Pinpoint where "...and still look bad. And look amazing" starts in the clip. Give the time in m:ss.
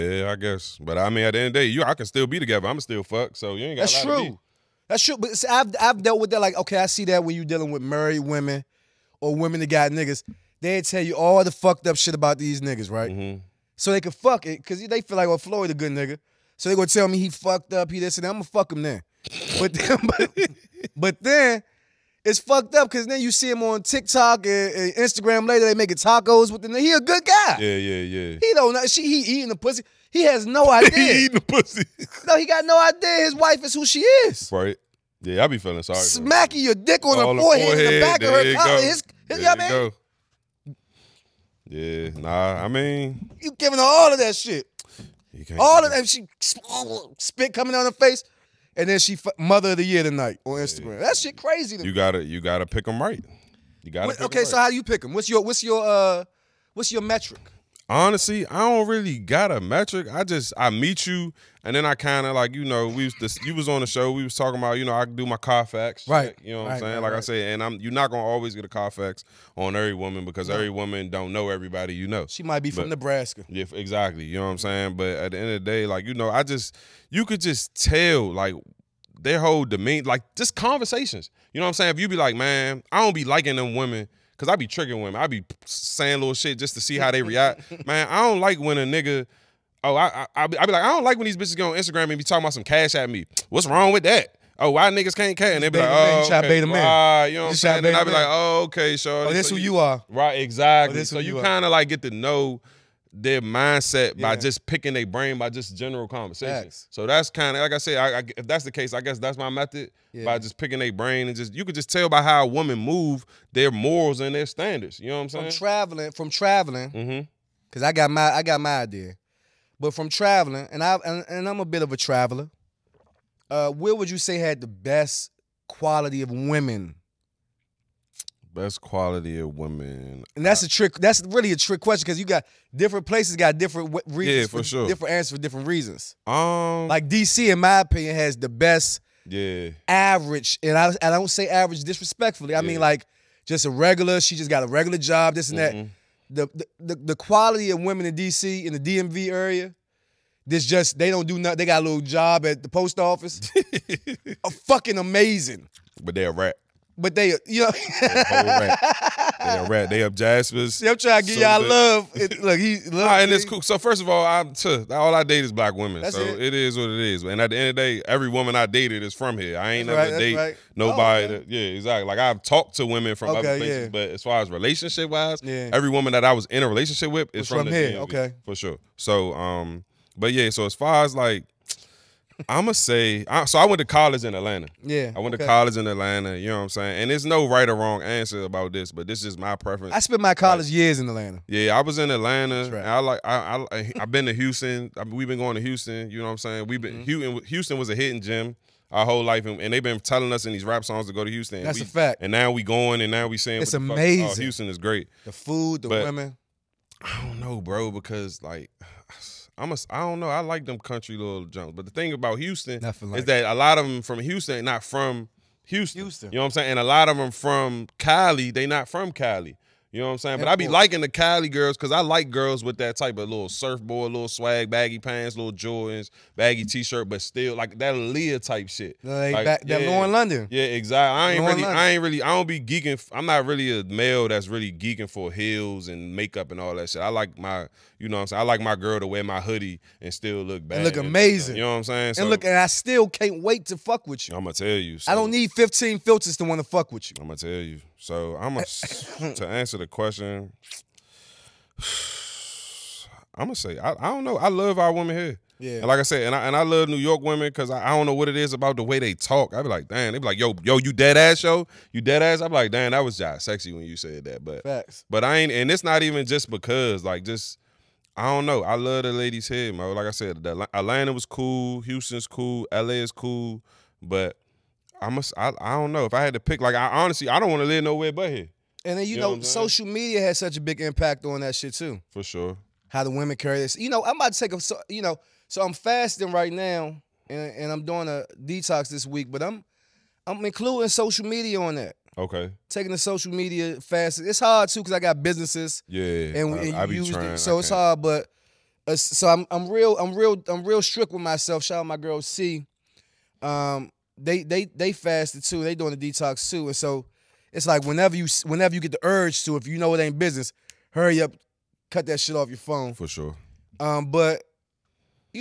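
4:00.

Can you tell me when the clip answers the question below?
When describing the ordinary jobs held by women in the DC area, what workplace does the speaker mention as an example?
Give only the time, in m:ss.
2:32.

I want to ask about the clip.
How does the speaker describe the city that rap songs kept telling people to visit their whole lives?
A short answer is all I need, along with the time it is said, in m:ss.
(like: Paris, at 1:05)
hidden gem, at 3:17.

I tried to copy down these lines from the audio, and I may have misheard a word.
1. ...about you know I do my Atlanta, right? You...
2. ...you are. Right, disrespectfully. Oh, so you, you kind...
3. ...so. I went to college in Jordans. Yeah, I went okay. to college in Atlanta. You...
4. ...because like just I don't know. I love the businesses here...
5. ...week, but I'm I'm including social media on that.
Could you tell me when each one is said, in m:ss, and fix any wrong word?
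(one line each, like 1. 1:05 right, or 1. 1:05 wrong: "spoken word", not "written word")
1. 1:04 wrong: "Carfax", not "Atlanta"
2. 1:39 wrong: "exactly", not "disrespectfully"
3. 3:03 wrong: "Atlanta", not "Jordans"
4. 4:26 wrong: "ladies", not "businesses"
5. 4:49 right.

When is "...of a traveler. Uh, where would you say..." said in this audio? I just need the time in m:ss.
2:01.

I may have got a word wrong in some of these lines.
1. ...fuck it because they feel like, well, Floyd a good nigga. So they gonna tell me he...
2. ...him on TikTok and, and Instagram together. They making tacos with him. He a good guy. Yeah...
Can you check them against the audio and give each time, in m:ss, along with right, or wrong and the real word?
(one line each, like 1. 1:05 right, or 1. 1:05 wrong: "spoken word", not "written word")
1. 0:14 right
2. 0:23 wrong: "later", not "together".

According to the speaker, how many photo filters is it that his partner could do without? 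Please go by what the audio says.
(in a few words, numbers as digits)
15.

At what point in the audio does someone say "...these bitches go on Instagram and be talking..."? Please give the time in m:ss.
1:31.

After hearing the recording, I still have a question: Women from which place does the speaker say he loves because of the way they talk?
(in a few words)
New York.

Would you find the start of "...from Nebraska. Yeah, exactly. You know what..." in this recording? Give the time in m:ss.
1:12.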